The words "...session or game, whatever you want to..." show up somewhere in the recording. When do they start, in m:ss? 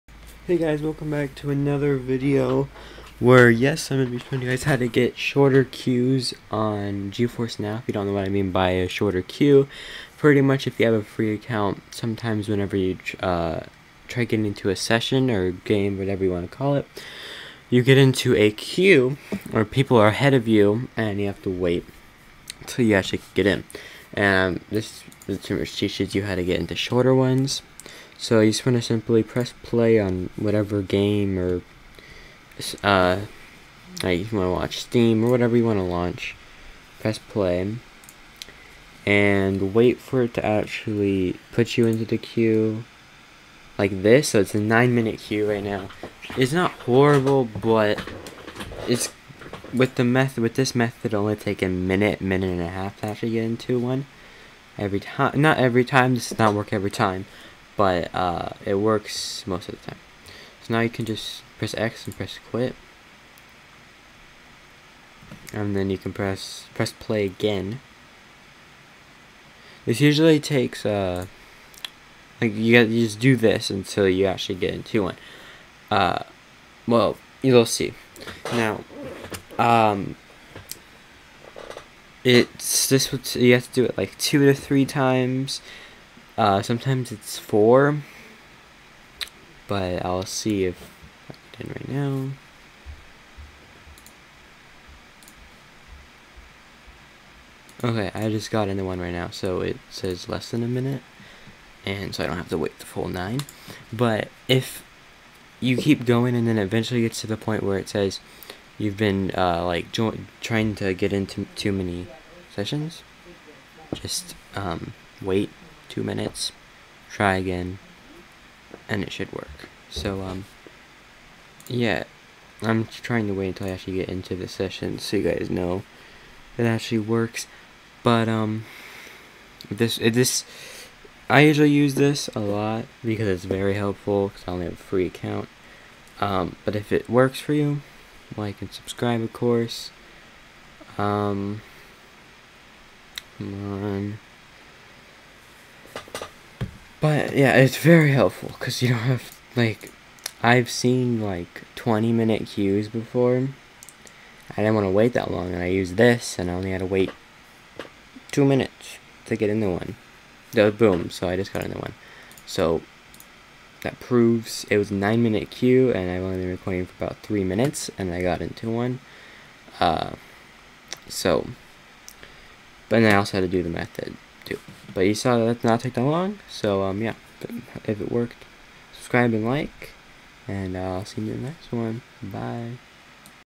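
0:14.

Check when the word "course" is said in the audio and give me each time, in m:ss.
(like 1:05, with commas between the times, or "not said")
2:19.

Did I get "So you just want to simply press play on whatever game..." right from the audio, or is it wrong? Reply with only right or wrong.
right.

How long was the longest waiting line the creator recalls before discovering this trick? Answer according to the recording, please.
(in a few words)
20 minute.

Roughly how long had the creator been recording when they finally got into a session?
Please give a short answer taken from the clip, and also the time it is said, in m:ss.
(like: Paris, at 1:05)
about 3 minutes, at 2:47.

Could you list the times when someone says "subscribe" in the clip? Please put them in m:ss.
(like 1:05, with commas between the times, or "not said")
2:18, 2:58.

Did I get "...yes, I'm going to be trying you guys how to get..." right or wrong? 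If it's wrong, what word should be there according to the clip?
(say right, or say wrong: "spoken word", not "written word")
wrong: "showing", not "trying".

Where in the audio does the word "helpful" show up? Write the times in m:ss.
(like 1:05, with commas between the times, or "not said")
2:13, 2:28.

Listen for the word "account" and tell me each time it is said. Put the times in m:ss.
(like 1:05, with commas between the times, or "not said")
0:11, 2:15.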